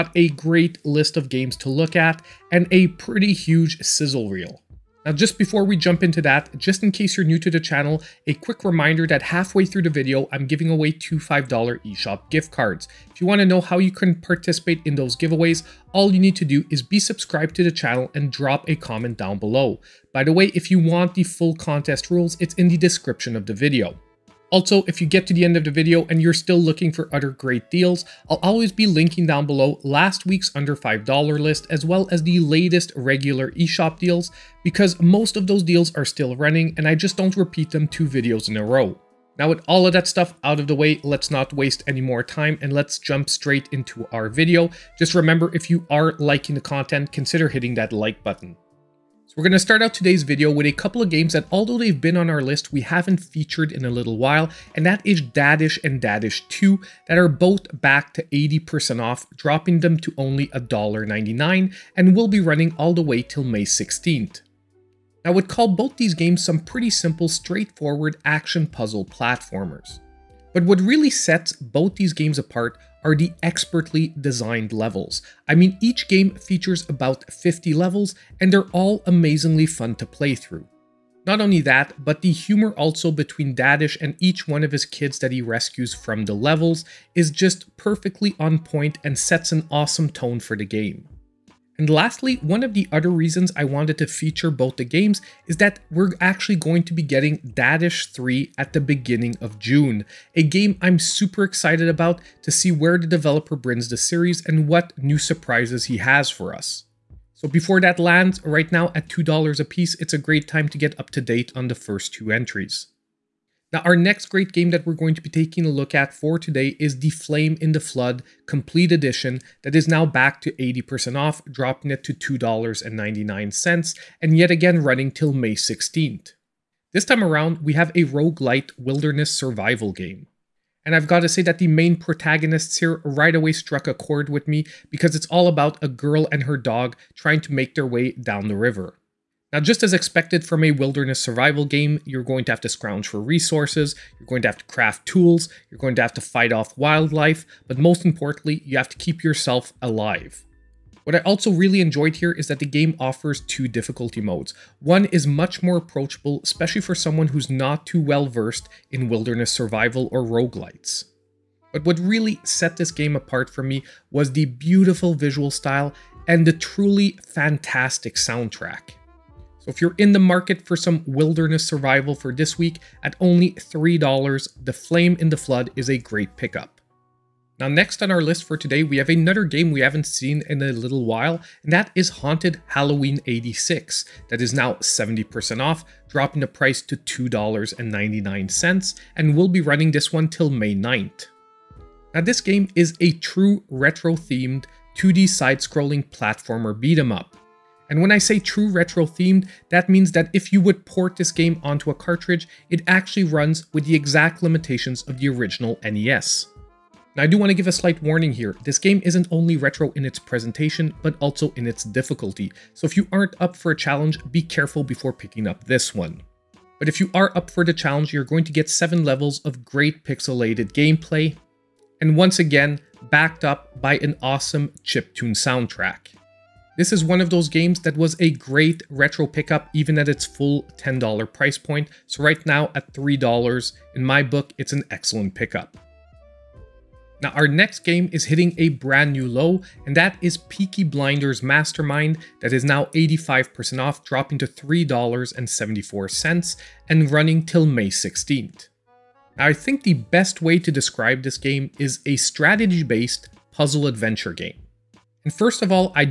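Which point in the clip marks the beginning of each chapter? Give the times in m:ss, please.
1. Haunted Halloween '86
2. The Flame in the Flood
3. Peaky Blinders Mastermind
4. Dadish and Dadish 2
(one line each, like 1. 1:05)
1. 2:57
2. 1:53
3. 3:56
4. 0:49.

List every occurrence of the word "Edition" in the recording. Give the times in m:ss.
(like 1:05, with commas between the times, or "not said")
1:58.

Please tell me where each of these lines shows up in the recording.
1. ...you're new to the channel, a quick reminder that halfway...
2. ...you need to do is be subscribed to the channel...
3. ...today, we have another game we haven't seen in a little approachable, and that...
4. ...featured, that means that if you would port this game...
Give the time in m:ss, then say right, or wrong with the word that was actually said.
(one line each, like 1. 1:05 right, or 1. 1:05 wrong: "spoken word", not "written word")
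1. 0:07 right
2. 0:16 right
3. 2:58 wrong: "while", not "approachable"
4. 3:19 wrong: "themed", not "featured".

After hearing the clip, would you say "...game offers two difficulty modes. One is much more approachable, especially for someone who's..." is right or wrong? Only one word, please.
right.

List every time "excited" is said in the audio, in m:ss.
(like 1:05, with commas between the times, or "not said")
1:41.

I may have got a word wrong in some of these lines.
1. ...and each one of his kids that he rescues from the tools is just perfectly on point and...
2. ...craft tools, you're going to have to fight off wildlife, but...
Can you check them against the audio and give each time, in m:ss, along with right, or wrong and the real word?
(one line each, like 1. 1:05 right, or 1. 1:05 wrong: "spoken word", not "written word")
1. 1:24 wrong: "levels", not "tools"
2. 2:24 right.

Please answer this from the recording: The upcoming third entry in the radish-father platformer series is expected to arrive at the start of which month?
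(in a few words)
June.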